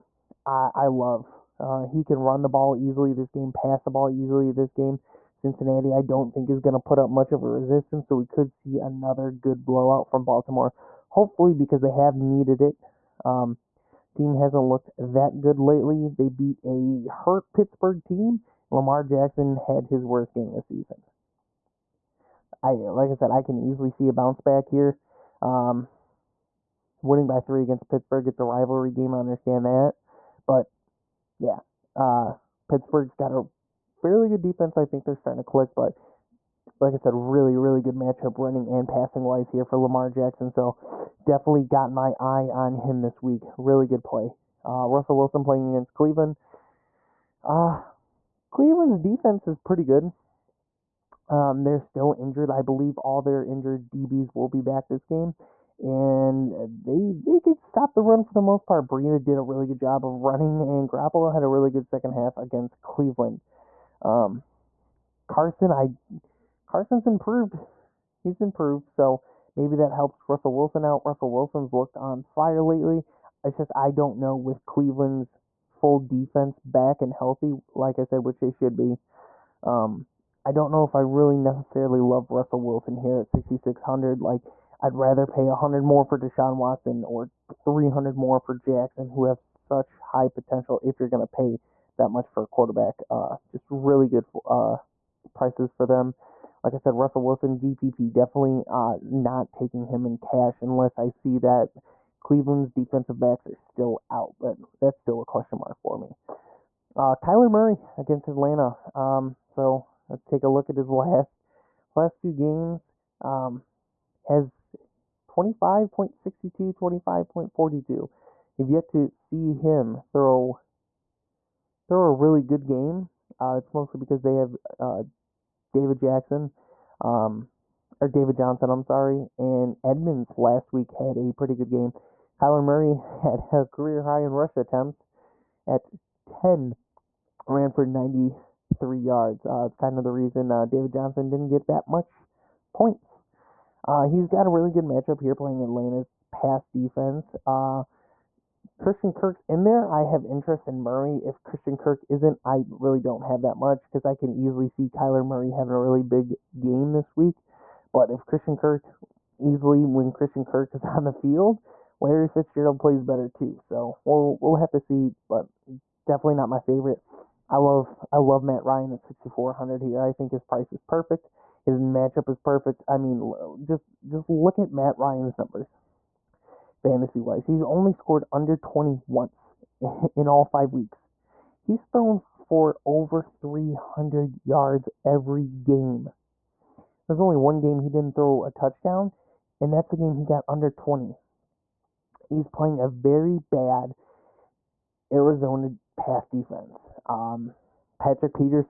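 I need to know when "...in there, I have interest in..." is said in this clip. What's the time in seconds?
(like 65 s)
149 s.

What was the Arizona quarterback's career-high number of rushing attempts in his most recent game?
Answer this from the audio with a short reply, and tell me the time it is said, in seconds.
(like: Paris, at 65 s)
10, at 136 s.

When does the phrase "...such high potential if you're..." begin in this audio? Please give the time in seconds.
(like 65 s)
89 s.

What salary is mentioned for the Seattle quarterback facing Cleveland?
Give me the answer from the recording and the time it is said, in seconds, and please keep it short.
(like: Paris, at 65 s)
6600, at 83 s.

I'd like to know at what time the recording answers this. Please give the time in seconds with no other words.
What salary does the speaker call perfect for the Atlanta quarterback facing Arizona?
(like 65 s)
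169 s.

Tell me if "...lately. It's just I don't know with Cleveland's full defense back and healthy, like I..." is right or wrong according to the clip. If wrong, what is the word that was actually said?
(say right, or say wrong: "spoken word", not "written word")
right.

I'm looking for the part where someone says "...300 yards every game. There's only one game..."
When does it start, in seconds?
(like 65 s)
183 s.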